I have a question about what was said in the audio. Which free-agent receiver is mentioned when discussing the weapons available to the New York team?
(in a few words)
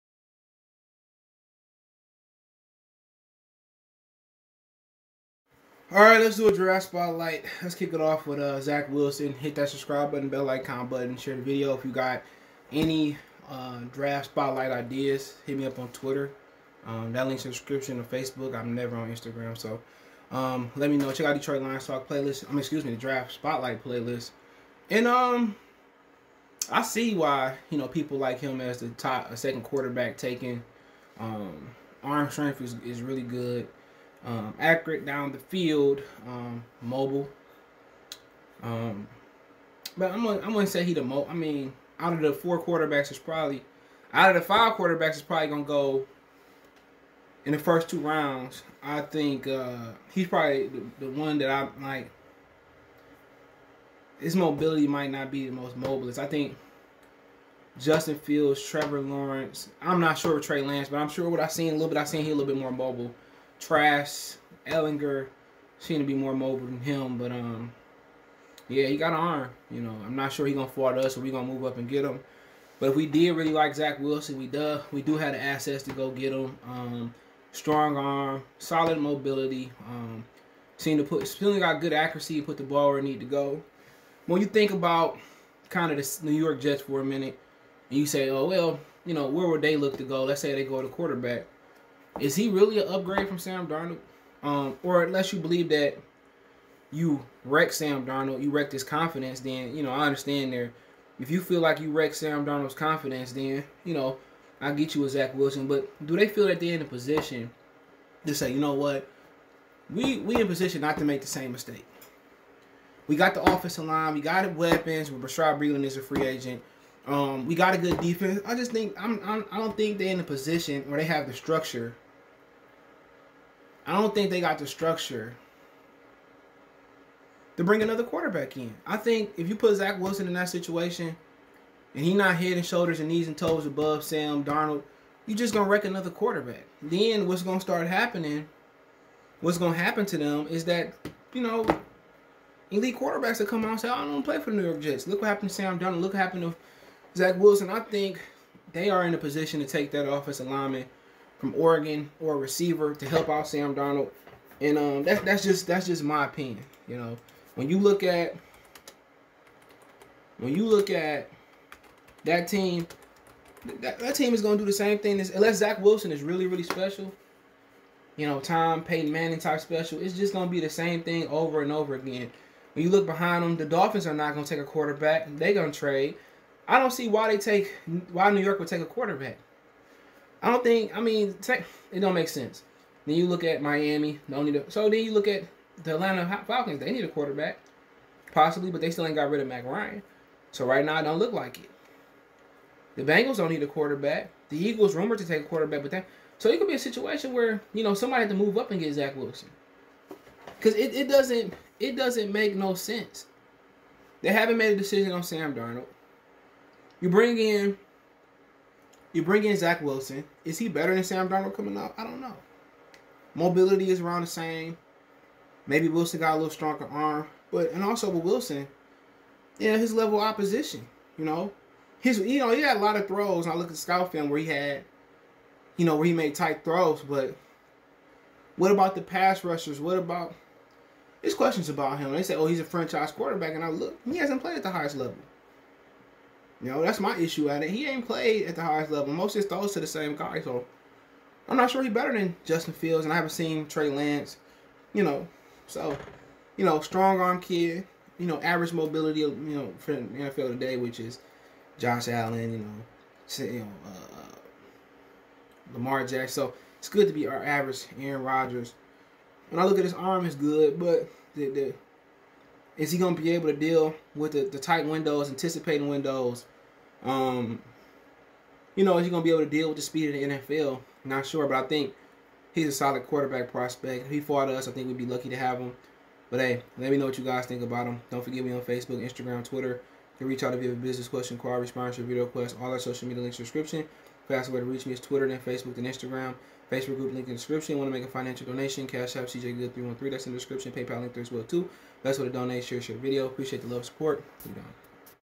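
Breshad Perriman.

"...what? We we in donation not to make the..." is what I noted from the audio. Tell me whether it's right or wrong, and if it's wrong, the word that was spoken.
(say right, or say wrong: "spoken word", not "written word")
wrong: "position", not "donation".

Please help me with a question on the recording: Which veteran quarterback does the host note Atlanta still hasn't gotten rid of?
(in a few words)
Matt Ryan.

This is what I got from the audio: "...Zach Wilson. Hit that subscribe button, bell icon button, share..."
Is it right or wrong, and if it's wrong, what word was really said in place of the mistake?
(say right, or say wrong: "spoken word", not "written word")
right.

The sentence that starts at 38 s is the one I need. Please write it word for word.
Um, but I'm gonna, I'm gonna say he the most.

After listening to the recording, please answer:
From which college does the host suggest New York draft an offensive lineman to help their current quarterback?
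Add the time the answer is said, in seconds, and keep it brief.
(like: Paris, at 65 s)
Oregon, at 151 s.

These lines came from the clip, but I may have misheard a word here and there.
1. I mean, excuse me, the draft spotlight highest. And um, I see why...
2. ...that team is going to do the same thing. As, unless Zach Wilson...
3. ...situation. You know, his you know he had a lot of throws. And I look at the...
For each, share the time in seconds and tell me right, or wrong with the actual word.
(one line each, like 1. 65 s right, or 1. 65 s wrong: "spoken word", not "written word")
1. 22 s wrong: "playlist", not "highest"
2. 163 s right
3. 220 s wrong: "opposition", not "situation".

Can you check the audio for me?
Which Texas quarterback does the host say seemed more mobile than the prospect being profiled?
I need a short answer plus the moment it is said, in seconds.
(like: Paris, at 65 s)
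Ehlinger, at 64 s.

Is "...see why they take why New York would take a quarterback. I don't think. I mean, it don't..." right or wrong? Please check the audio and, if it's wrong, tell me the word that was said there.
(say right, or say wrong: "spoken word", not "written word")
right.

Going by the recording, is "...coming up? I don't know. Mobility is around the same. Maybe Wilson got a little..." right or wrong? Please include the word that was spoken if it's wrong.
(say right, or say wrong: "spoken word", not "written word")
right.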